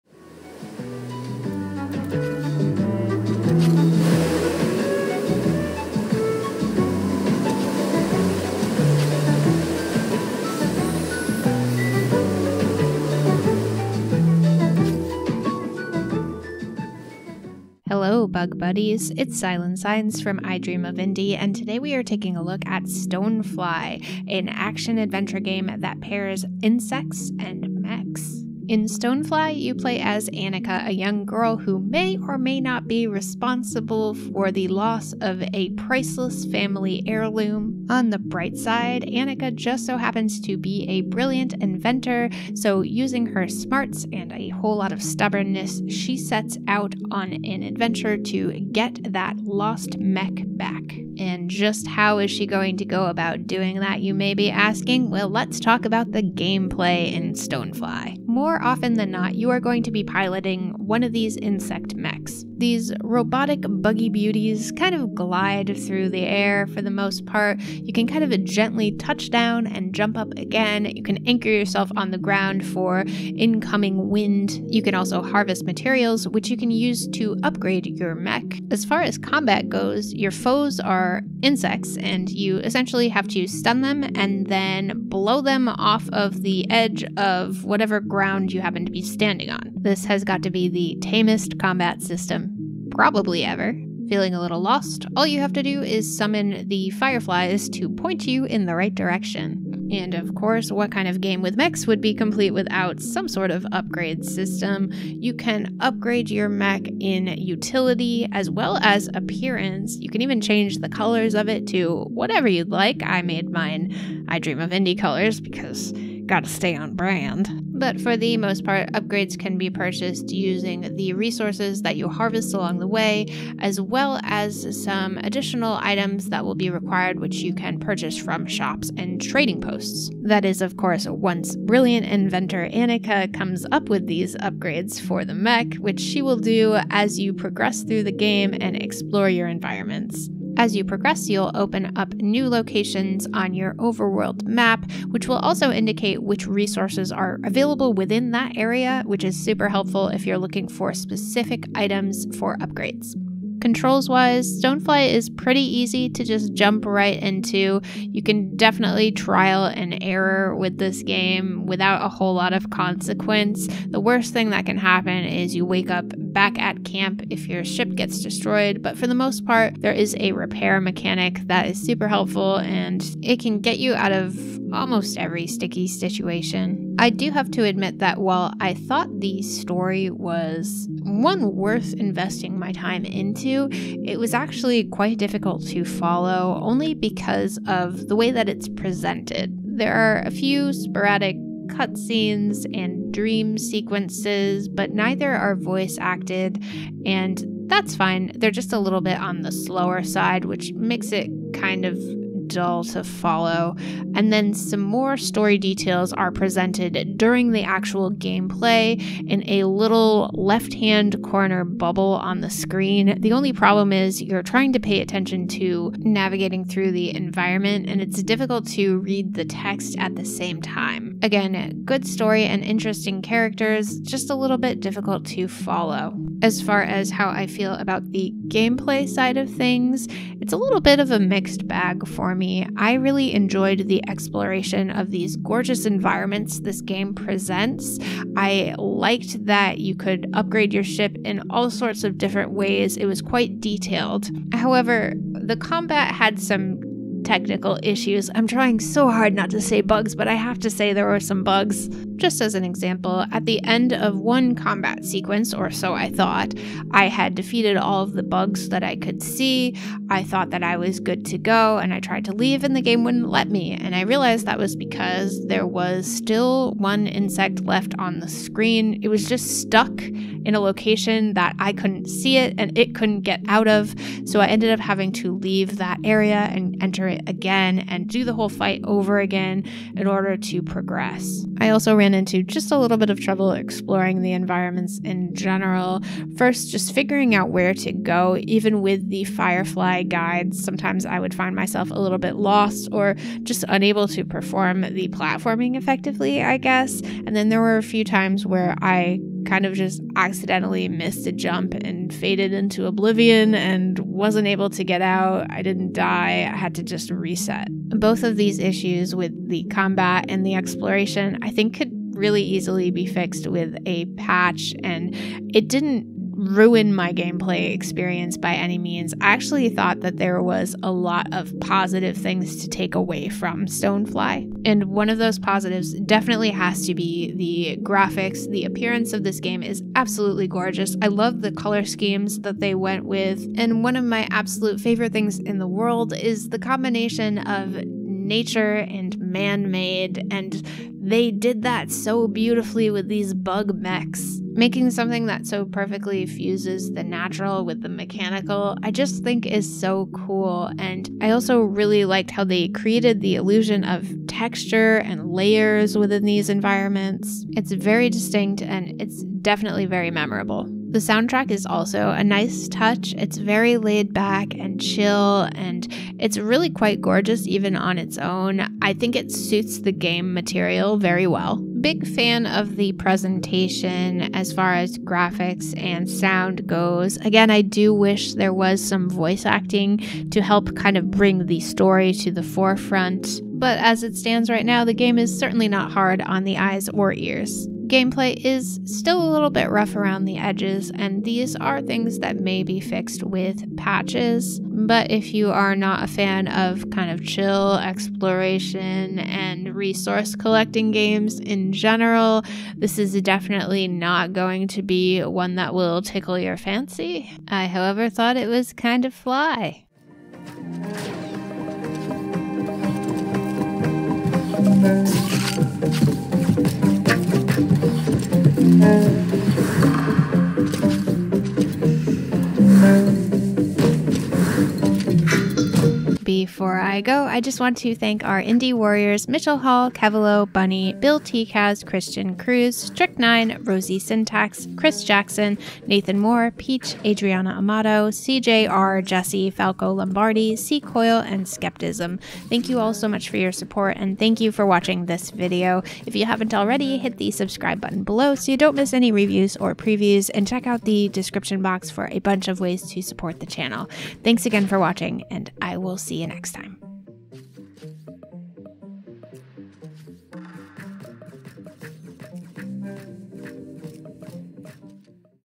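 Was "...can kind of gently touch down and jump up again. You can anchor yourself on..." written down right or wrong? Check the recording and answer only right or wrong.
right.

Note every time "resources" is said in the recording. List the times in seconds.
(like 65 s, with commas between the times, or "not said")
121 s, 146 s, 399 s.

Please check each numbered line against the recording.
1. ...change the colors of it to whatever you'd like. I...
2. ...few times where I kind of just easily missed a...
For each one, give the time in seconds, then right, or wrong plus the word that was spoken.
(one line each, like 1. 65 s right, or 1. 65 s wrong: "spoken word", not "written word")
1. 110 s right
2. 297 s wrong: "accidentally", not "easily".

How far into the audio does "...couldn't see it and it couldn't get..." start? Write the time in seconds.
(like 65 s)
271 s.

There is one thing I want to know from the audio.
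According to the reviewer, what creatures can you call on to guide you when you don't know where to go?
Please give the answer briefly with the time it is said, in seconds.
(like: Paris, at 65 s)
fireflies, at 96 s.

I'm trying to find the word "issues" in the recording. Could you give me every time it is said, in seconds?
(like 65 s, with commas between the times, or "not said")
247 s, 308 s.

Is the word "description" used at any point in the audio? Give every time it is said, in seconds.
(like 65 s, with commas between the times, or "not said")
451 s.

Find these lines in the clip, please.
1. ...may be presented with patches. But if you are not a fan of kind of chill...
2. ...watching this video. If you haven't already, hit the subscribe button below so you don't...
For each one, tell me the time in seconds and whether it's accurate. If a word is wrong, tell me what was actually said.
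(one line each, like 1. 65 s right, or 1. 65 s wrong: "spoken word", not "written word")
1. 392 s wrong: "fixed", not "presented"
2. 444 s right.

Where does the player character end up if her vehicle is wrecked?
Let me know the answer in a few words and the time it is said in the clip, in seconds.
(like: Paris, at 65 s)
back at camp, at 166 s.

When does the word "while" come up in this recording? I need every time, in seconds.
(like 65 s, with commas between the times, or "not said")
178 s.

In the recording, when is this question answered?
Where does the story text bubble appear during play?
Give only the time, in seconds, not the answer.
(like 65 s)
210 s.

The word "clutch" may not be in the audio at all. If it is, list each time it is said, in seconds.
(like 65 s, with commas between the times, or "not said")
not said.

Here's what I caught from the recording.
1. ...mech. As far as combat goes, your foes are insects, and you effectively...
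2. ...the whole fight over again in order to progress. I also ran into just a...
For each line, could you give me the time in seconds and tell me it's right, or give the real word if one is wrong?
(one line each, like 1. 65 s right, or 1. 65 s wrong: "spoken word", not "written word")
1. 78 s wrong: "essentially", not "effectively"
2. 278 s right.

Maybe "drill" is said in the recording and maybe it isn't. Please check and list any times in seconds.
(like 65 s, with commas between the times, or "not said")
not said.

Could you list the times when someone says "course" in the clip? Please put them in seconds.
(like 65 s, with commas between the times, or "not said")
100 s, 130 s.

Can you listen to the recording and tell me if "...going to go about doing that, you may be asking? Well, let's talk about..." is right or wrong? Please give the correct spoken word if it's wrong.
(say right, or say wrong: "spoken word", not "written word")
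right.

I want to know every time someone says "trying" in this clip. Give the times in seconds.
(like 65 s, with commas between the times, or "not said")
214 s, 248 s.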